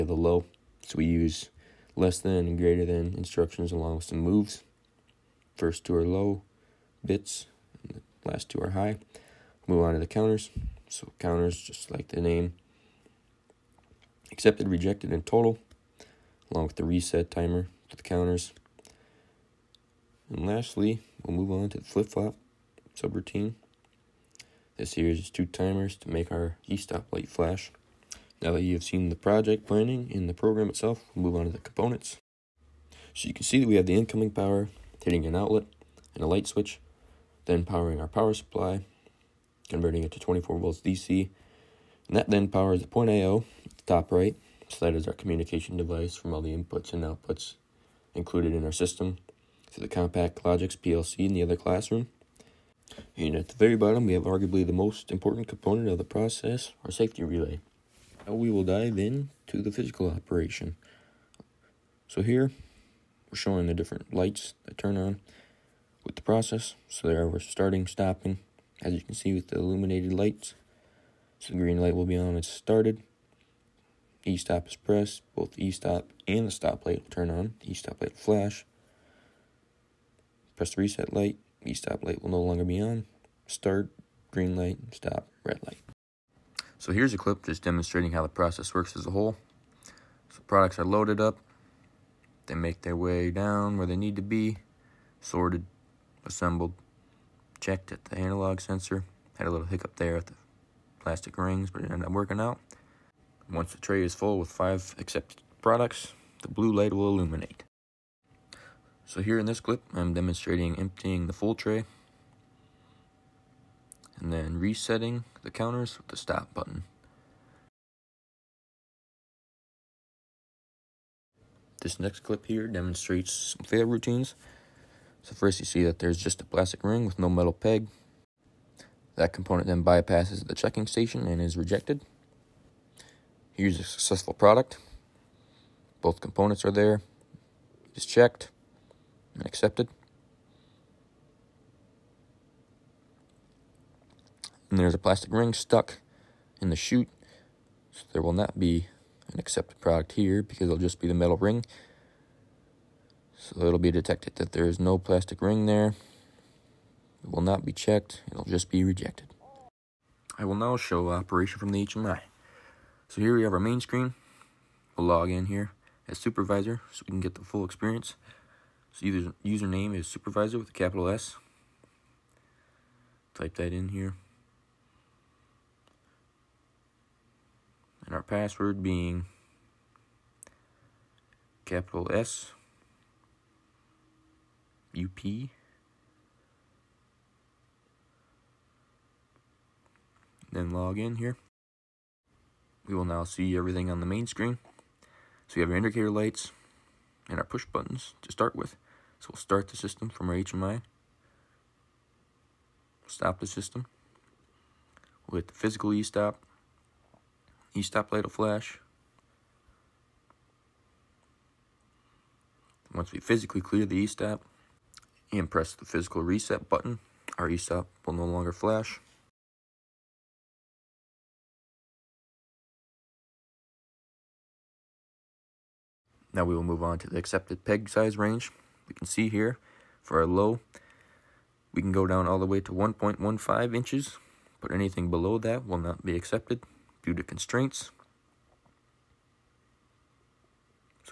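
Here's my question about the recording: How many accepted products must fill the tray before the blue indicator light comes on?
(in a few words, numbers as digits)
5.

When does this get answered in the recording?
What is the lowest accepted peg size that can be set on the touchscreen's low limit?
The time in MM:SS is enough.
03:52.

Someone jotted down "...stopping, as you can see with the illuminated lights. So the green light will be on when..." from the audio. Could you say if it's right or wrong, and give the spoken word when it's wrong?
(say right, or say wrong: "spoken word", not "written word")
right.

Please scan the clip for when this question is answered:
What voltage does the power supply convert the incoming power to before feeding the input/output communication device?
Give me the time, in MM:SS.
00:40.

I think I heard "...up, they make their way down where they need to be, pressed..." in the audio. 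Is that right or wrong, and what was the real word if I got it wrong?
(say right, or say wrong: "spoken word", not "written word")
wrong: "sorted", not "pressed".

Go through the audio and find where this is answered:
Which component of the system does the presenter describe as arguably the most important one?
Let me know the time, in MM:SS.
00:56.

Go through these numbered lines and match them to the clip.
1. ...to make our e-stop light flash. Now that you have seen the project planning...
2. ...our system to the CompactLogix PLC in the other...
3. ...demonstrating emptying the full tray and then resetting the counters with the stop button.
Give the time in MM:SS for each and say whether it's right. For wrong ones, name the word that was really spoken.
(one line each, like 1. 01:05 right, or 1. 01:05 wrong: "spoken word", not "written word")
1. 00:25 right
2. 00:48 right
3. 01:50 right.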